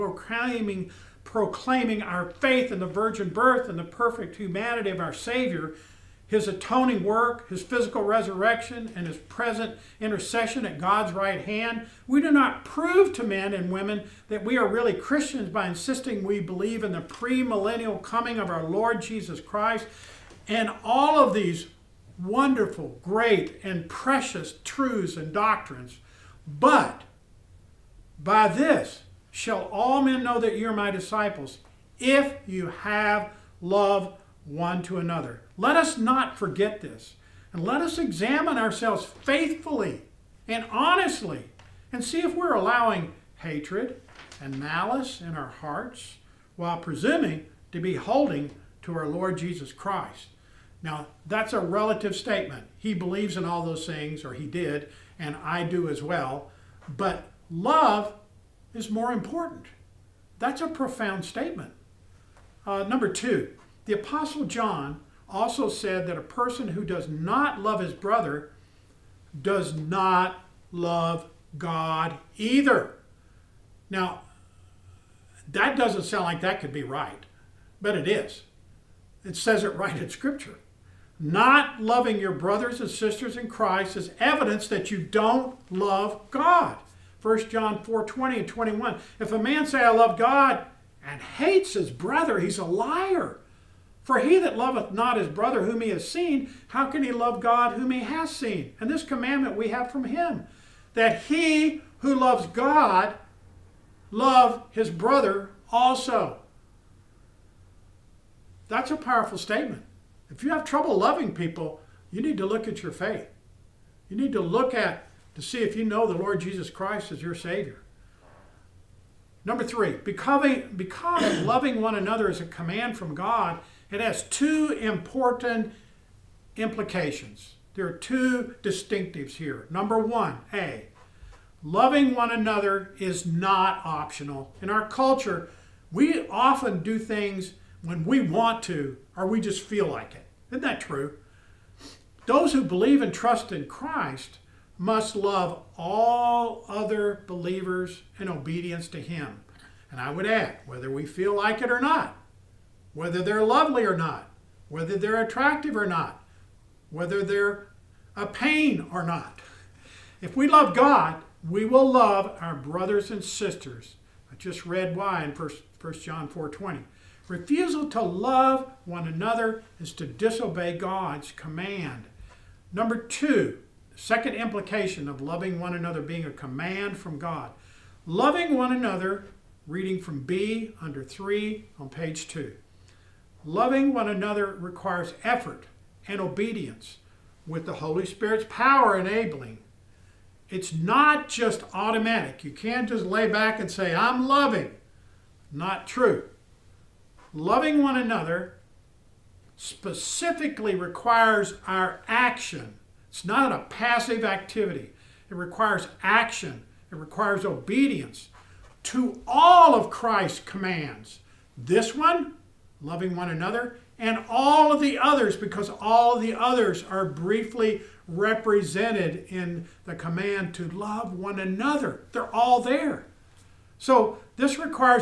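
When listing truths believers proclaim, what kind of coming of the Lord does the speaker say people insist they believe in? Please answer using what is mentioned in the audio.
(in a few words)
premillennial.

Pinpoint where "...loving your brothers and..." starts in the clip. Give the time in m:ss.
1:21.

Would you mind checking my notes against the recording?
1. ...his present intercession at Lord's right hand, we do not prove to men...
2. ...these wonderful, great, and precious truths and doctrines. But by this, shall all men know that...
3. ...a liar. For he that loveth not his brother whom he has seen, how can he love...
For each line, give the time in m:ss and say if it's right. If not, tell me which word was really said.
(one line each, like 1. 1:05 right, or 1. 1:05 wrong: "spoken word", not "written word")
1. 0:09 wrong: "God", not "Lord"
2. 0:21 right
3. 1:32 right.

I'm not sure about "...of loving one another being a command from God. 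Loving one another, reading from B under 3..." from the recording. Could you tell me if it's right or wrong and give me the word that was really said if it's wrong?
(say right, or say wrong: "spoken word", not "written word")
right.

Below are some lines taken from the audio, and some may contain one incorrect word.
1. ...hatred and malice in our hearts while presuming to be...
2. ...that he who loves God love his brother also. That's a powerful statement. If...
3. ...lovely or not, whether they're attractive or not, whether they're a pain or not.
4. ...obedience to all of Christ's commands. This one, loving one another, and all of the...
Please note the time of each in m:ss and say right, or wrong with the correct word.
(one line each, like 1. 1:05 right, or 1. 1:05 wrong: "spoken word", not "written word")
1. 0:43 right
2. 1:40 right
3. 2:33 right
4. 3:27 right.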